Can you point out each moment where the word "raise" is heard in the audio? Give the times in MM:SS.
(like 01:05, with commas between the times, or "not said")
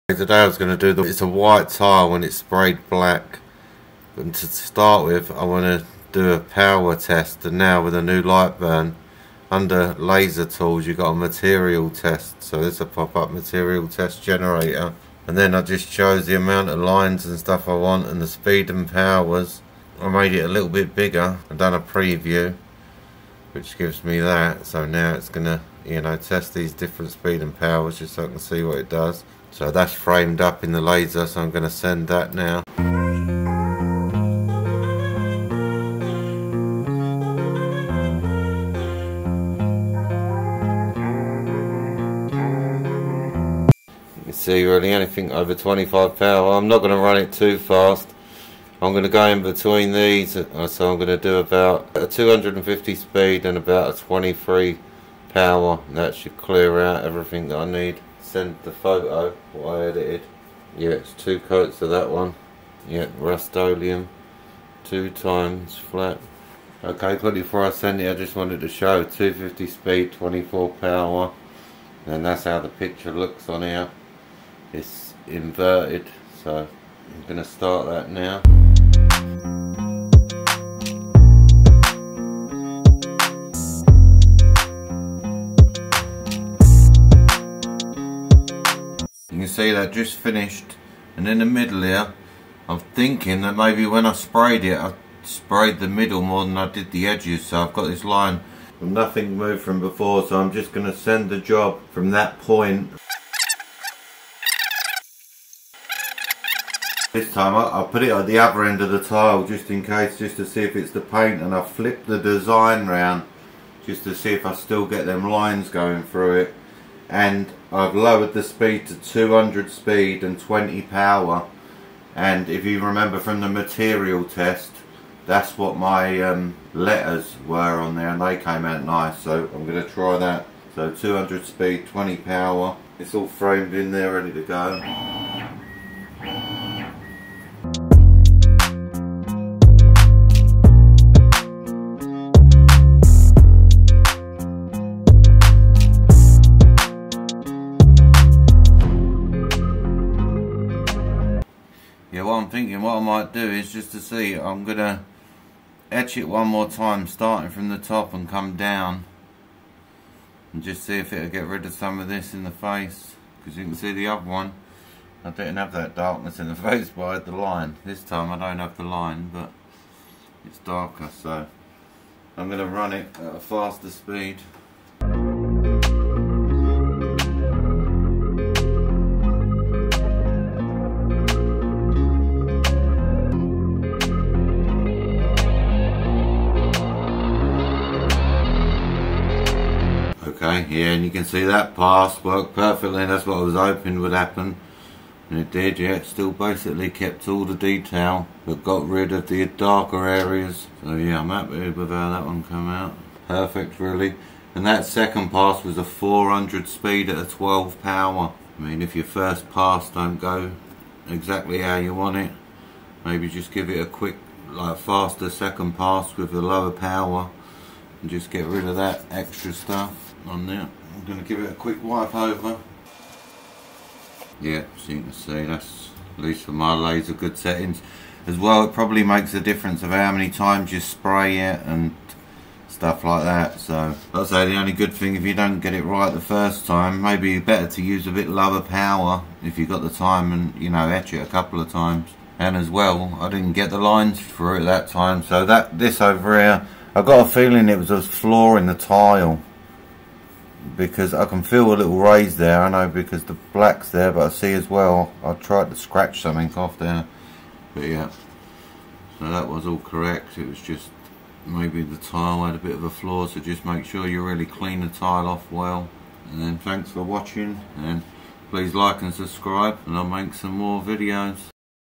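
04:11.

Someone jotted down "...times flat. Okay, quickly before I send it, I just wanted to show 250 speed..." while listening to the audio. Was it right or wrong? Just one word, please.
right.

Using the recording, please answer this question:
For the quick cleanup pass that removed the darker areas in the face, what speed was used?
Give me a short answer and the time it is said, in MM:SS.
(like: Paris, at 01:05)
400, at 03:25.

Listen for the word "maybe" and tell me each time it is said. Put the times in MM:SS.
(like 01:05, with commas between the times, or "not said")
01:33, 03:33, 03:57, 04:21.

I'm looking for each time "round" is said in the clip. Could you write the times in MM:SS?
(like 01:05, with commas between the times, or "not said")
01:52.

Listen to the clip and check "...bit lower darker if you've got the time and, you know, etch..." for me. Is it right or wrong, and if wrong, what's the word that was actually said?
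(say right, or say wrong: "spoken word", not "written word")
wrong: "power", not "darker".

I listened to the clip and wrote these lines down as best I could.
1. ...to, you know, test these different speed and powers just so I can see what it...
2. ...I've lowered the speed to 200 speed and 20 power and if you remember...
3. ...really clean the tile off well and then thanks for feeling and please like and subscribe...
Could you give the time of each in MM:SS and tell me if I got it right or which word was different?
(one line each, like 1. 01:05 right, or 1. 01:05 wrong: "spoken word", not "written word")
1. 00:25 right
2. 01:57 right
3. 04:24 wrong: "watching", not "feeling".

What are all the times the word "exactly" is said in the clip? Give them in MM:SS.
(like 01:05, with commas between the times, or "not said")
03:31.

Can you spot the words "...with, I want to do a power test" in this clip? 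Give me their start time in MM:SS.
00:05.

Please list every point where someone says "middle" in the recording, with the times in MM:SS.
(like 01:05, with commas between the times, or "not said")
01:31, 01:35.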